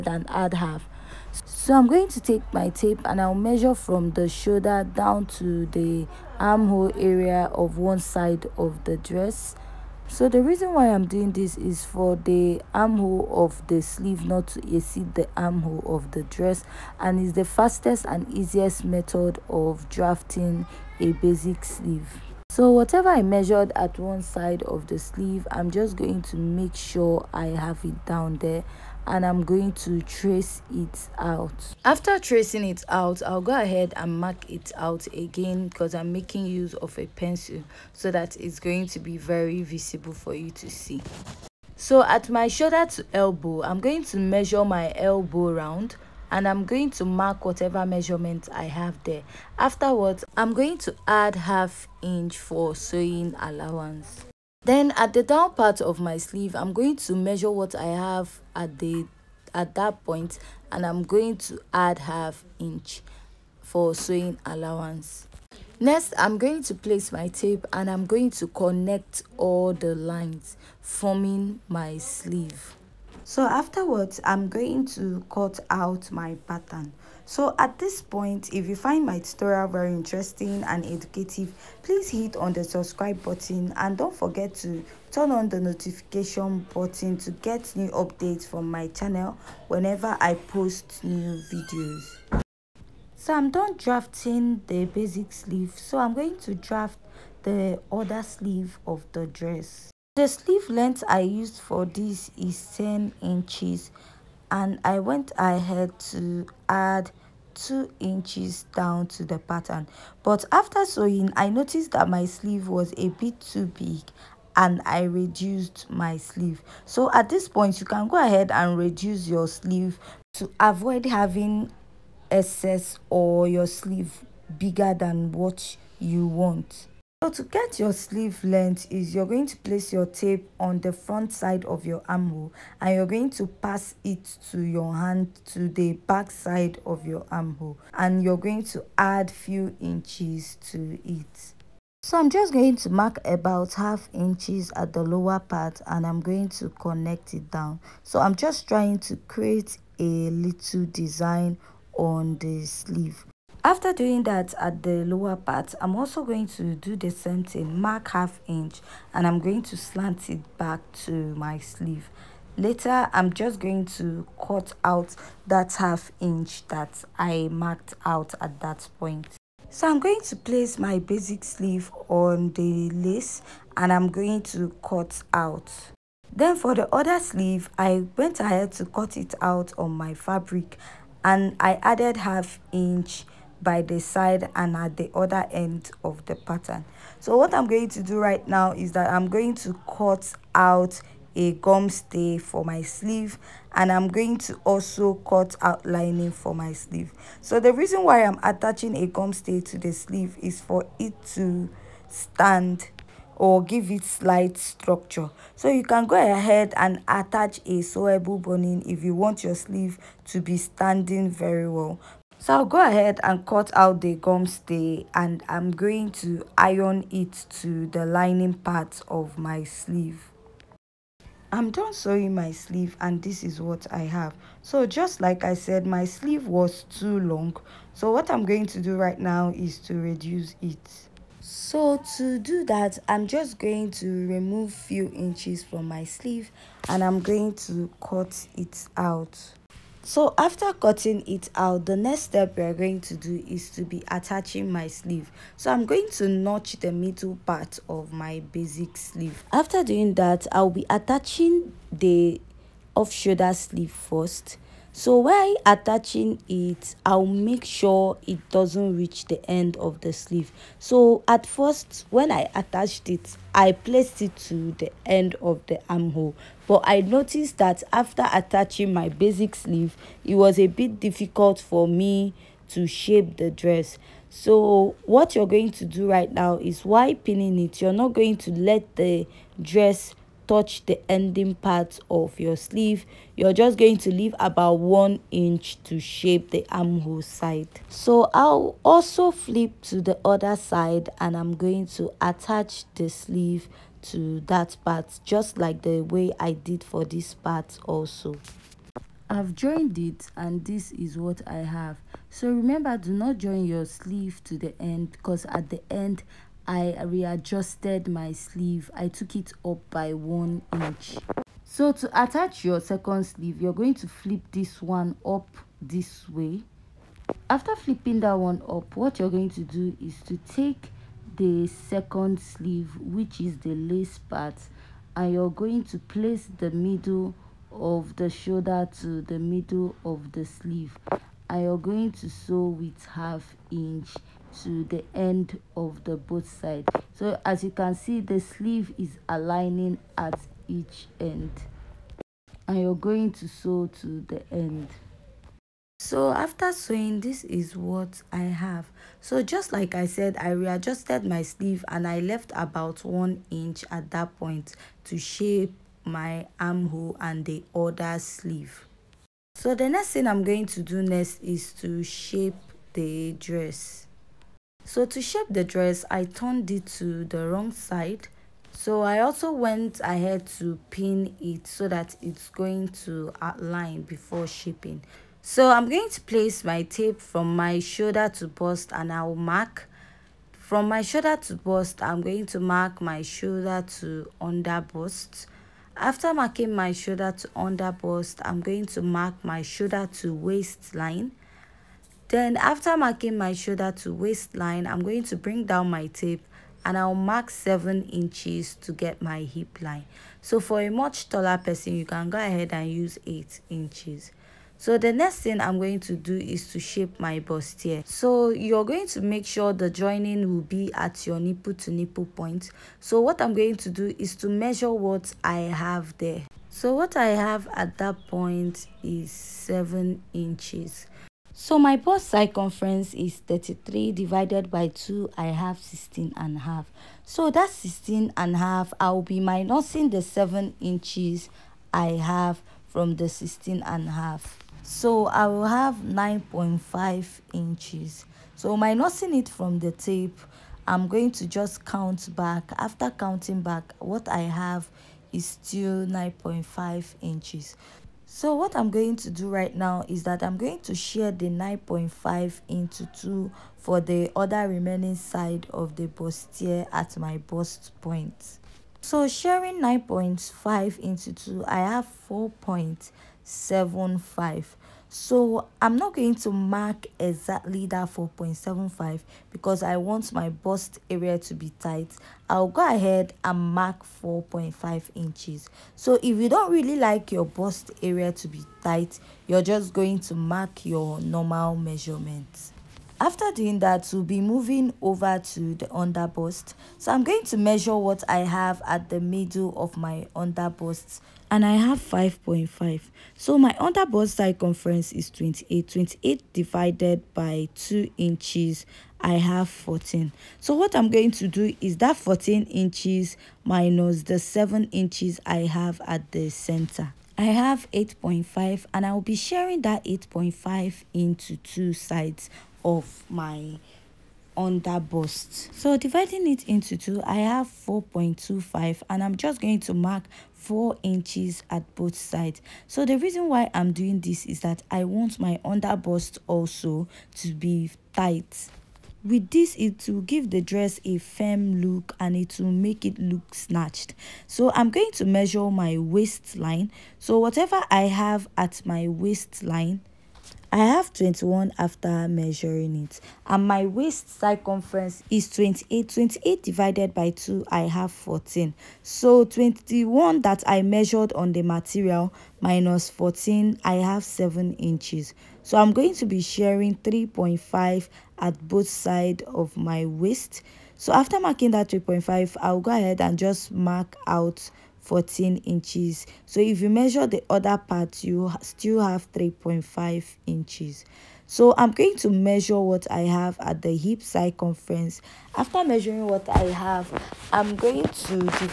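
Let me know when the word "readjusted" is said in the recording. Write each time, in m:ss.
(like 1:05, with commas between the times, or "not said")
5:07, 5:50.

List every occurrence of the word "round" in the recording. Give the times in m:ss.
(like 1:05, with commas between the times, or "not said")
0:45.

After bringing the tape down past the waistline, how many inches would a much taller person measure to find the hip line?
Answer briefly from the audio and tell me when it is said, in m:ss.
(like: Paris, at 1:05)
8 inches, at 6:43.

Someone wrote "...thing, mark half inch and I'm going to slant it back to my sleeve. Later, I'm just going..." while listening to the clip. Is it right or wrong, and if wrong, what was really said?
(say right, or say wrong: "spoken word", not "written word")
right.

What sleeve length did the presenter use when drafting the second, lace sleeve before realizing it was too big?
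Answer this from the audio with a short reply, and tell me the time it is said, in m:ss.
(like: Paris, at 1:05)
10 inches, at 1:42.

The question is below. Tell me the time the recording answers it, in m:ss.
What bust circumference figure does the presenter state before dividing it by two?
7:03.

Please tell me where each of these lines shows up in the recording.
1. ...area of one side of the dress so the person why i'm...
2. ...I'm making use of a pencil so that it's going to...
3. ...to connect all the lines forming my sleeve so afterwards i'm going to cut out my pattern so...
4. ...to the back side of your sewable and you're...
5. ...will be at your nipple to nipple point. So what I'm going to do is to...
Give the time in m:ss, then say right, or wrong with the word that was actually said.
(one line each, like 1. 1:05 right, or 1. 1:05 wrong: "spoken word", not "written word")
1. 0:06 wrong: "reason", not "person"
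2. 0:35 right
3. 1:08 right
4. 2:15 wrong: "armhole", not "sewable"
5. 6:50 right.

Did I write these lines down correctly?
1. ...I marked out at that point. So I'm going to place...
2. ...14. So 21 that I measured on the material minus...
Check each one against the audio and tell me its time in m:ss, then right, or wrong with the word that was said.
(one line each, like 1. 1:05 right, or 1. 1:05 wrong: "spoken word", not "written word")
1. 2:47 right
2. 9:08 right.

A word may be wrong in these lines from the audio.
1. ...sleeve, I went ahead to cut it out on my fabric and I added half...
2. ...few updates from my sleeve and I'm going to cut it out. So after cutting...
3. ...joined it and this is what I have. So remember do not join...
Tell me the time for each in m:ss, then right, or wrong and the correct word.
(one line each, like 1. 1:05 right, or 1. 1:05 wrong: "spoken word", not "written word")
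1. 2:57 right
2. 3:54 wrong: "inches", not "updates"
3. 4:59 right.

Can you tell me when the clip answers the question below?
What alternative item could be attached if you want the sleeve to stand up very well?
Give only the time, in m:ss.
3:27.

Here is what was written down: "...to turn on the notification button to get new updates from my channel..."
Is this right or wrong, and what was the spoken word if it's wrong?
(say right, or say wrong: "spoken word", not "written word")
right.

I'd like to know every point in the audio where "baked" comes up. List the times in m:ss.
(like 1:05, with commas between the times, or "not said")
not said.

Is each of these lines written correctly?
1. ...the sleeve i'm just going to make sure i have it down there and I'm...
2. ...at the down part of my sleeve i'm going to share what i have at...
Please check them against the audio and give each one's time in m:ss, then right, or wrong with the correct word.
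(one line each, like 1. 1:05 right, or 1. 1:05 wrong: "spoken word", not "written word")
1. 0:24 right
2. 0:54 wrong: "measure", not "share".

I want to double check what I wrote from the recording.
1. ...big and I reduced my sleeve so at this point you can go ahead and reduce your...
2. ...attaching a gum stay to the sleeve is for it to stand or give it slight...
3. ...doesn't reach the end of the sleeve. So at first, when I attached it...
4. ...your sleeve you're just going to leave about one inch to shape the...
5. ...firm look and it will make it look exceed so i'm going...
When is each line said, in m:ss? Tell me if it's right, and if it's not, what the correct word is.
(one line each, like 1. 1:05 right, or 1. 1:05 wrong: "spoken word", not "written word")
1. 1:53 right
2. 3:18 right
3. 4:18 right
4. 4:42 right
5. 8:51 wrong: "snatched", not "exceed".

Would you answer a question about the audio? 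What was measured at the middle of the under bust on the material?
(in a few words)
5.5.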